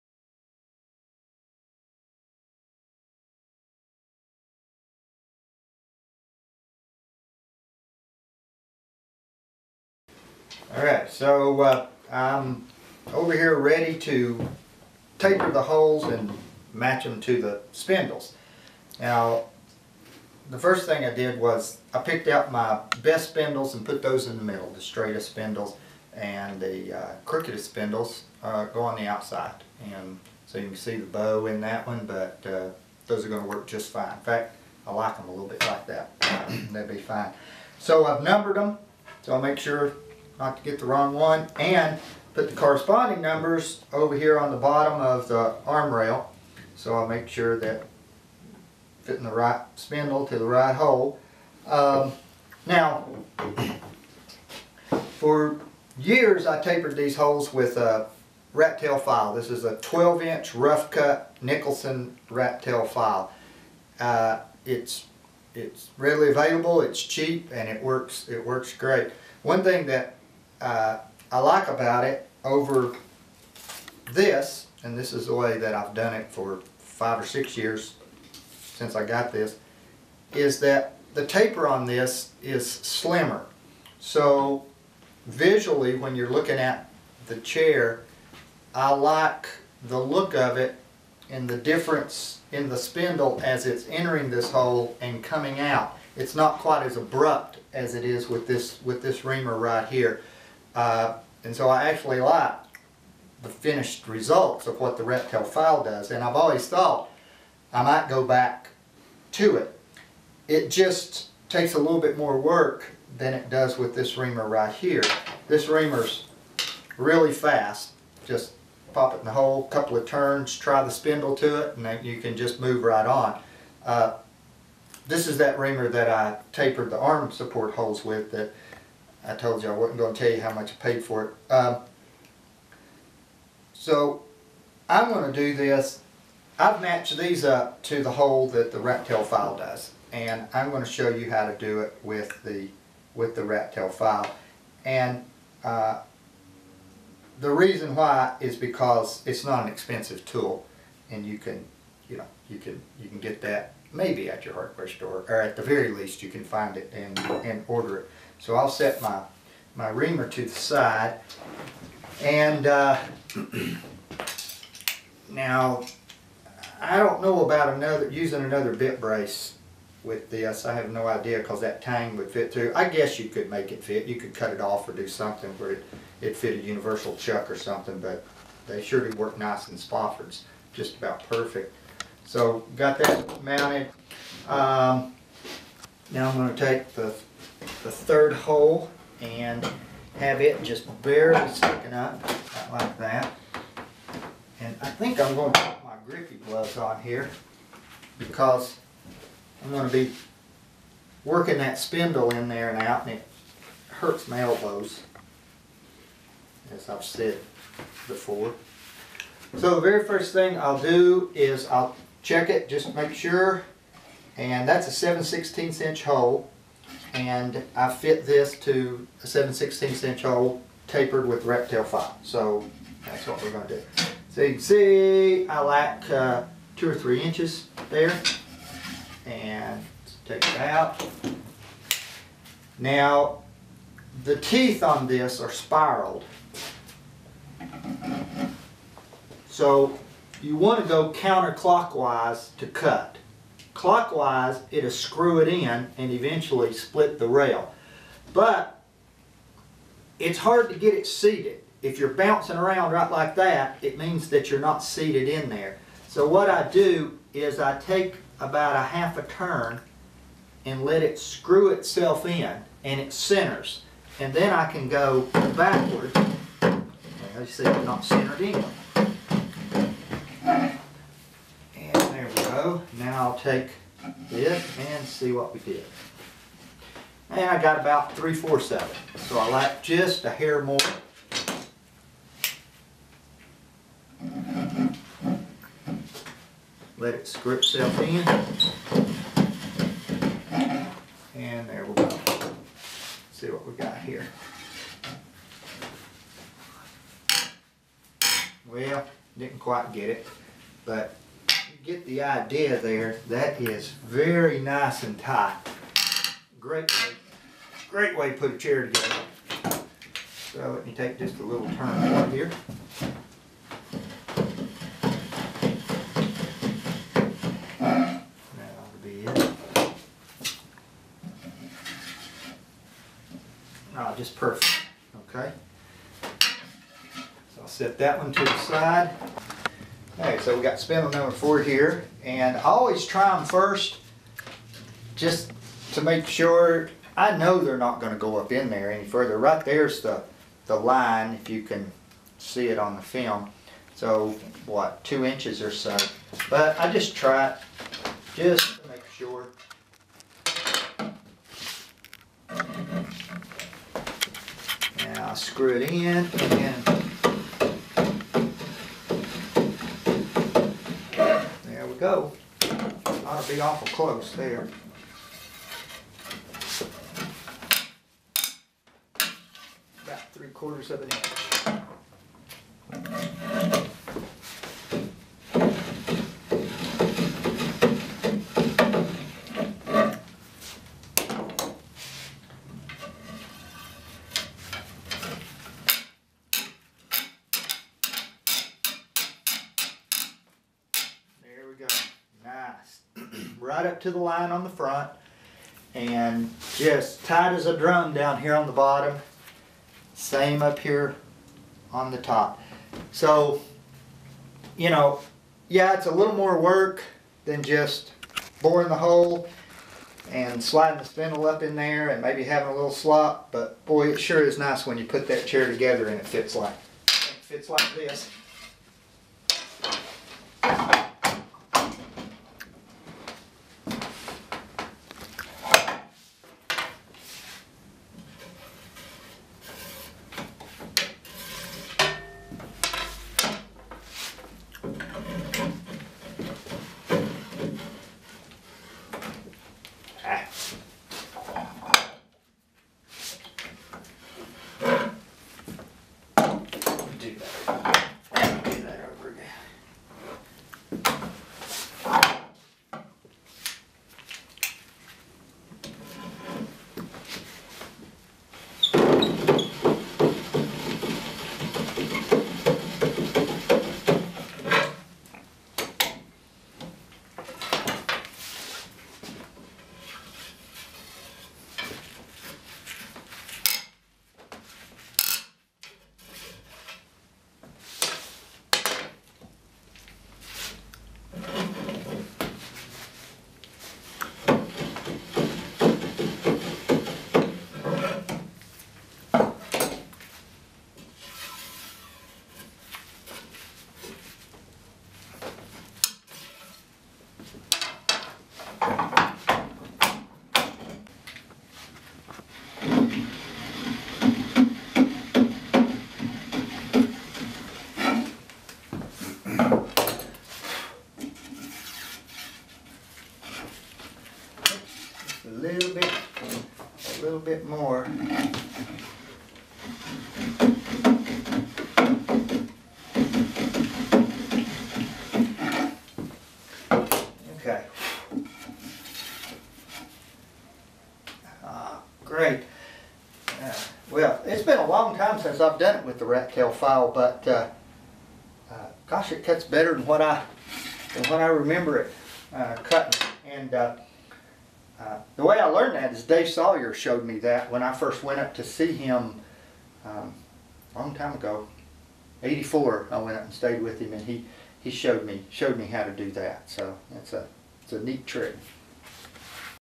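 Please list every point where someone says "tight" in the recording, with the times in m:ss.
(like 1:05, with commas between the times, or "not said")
5:05, 6:37.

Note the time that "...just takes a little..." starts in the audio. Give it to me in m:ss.
1:50.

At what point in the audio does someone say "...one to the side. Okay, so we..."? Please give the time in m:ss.
5:28.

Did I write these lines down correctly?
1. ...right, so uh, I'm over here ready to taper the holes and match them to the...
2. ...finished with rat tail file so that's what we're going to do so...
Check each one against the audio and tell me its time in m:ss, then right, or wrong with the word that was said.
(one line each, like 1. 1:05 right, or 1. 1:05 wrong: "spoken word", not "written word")
1. 0:10 right
2. 3:40 wrong: "tapered", not "finished".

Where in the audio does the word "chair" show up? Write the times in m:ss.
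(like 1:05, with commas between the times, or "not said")
1:27, 5:08, 6:55.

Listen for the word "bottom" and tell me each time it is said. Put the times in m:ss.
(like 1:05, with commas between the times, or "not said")
0:44, 6:38.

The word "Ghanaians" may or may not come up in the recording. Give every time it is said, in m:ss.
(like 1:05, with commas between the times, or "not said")
not said.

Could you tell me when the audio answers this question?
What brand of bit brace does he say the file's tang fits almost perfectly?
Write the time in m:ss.
2:59.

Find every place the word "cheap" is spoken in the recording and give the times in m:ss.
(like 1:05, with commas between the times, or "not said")
1:07.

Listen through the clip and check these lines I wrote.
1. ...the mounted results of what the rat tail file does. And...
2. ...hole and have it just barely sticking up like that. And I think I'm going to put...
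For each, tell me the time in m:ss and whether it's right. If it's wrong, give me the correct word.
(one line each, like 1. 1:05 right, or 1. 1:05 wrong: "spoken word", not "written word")
1. 1:43 wrong: "finished", not "mounted"
2. 3:08 right.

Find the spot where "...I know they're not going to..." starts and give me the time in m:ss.
5:37.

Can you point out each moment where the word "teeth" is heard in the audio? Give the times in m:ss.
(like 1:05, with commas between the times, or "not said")
3:54.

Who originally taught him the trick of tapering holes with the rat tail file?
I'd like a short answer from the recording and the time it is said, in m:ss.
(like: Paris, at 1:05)
Dave Sawyer, at 9:06.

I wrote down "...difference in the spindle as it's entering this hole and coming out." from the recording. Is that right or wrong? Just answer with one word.
right.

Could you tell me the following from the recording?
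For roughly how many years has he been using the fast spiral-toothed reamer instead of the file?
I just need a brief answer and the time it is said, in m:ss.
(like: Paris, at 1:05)
5 or 6, at 1:16.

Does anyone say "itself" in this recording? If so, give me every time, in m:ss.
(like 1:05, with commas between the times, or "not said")
4:21, 4:47.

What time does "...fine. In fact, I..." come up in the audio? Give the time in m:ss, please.
0:33.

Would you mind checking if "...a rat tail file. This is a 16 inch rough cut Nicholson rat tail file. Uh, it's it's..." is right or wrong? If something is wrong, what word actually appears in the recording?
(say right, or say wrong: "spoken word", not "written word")
wrong: "12", not "16".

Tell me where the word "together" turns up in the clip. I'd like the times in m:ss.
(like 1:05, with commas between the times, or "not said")
5:08, 6:55.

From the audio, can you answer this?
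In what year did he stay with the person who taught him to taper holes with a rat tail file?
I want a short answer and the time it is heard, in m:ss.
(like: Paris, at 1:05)
1984, at 9:12.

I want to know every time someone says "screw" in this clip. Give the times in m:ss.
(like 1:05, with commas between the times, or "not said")
4:04, 4:21, 4:47, 5:55.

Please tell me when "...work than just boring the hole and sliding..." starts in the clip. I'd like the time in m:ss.
6:46.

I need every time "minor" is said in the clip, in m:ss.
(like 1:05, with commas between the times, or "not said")
not said.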